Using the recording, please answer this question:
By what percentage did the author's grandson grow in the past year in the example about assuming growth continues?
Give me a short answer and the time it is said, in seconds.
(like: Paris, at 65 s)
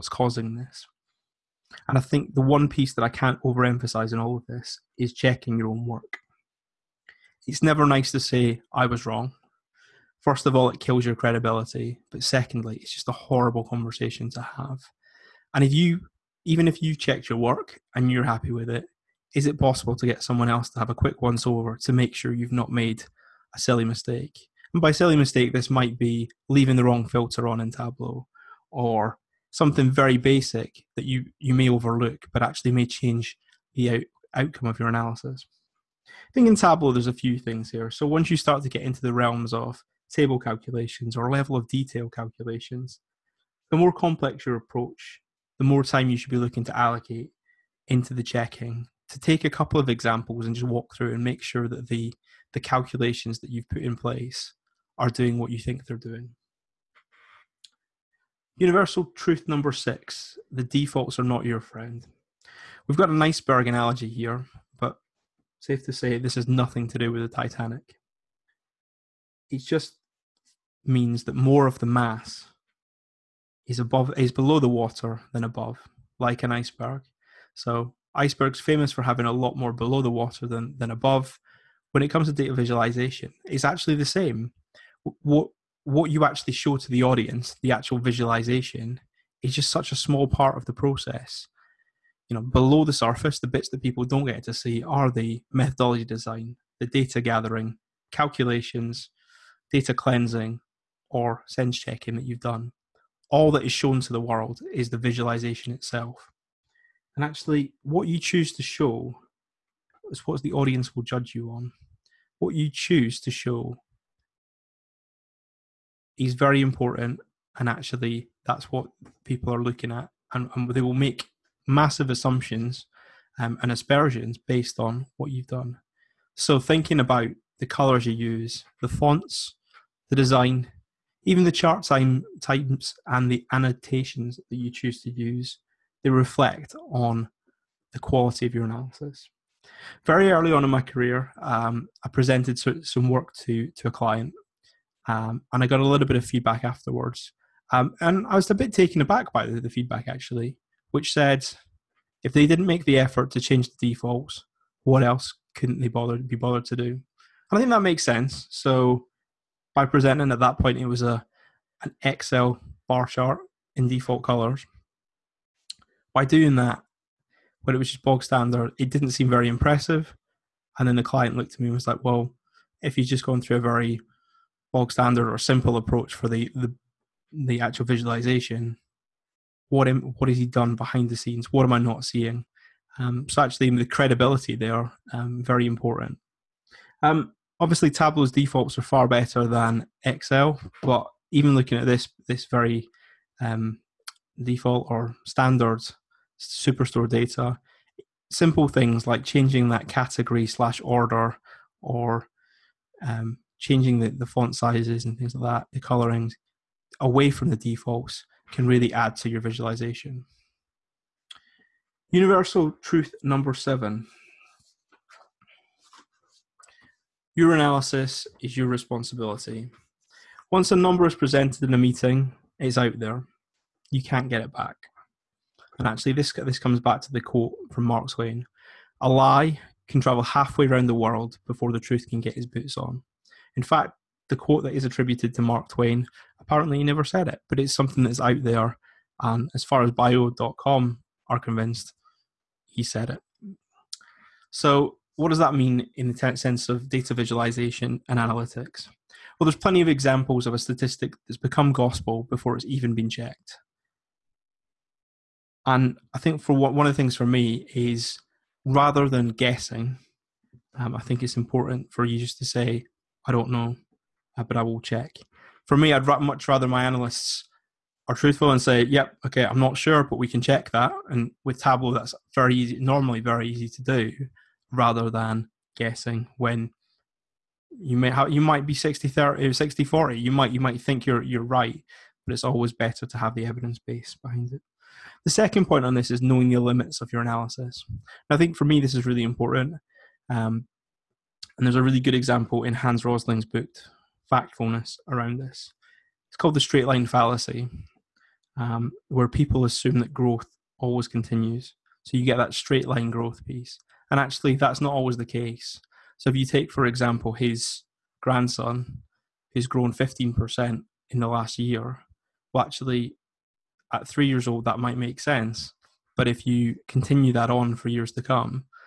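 15%, at 309 s.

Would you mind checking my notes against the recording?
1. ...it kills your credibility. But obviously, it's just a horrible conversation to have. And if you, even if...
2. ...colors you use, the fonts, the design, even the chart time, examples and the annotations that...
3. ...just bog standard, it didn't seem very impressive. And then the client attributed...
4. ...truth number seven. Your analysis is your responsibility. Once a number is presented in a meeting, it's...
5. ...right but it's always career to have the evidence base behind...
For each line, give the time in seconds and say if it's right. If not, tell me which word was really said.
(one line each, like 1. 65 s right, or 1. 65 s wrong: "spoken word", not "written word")
1. 10 s wrong: "secondly", not "obviously"
2. 127 s wrong: "types", not "examples"
3. 167 s wrong: "looked", not "attributed"
4. 212 s right
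5. 281 s wrong: "better", not "career".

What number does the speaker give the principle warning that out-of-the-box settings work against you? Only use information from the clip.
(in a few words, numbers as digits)
6.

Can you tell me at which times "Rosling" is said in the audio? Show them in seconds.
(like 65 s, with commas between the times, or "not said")
293 s.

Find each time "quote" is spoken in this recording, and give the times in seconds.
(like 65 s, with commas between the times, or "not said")
227 s, 234 s.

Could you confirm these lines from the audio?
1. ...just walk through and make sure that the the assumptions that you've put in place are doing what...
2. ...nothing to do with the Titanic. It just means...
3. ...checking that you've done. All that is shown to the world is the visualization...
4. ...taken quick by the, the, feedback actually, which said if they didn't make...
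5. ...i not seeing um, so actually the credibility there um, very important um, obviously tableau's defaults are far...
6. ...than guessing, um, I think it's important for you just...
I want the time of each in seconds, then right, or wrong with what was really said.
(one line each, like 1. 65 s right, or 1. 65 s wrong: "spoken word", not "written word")
1. 50 s wrong: "calculations", not "assumptions"
2. 66 s right
3. 101 s right
4. 148 s wrong: "aback", not "quick"
5. 181 s right
6. 259 s right.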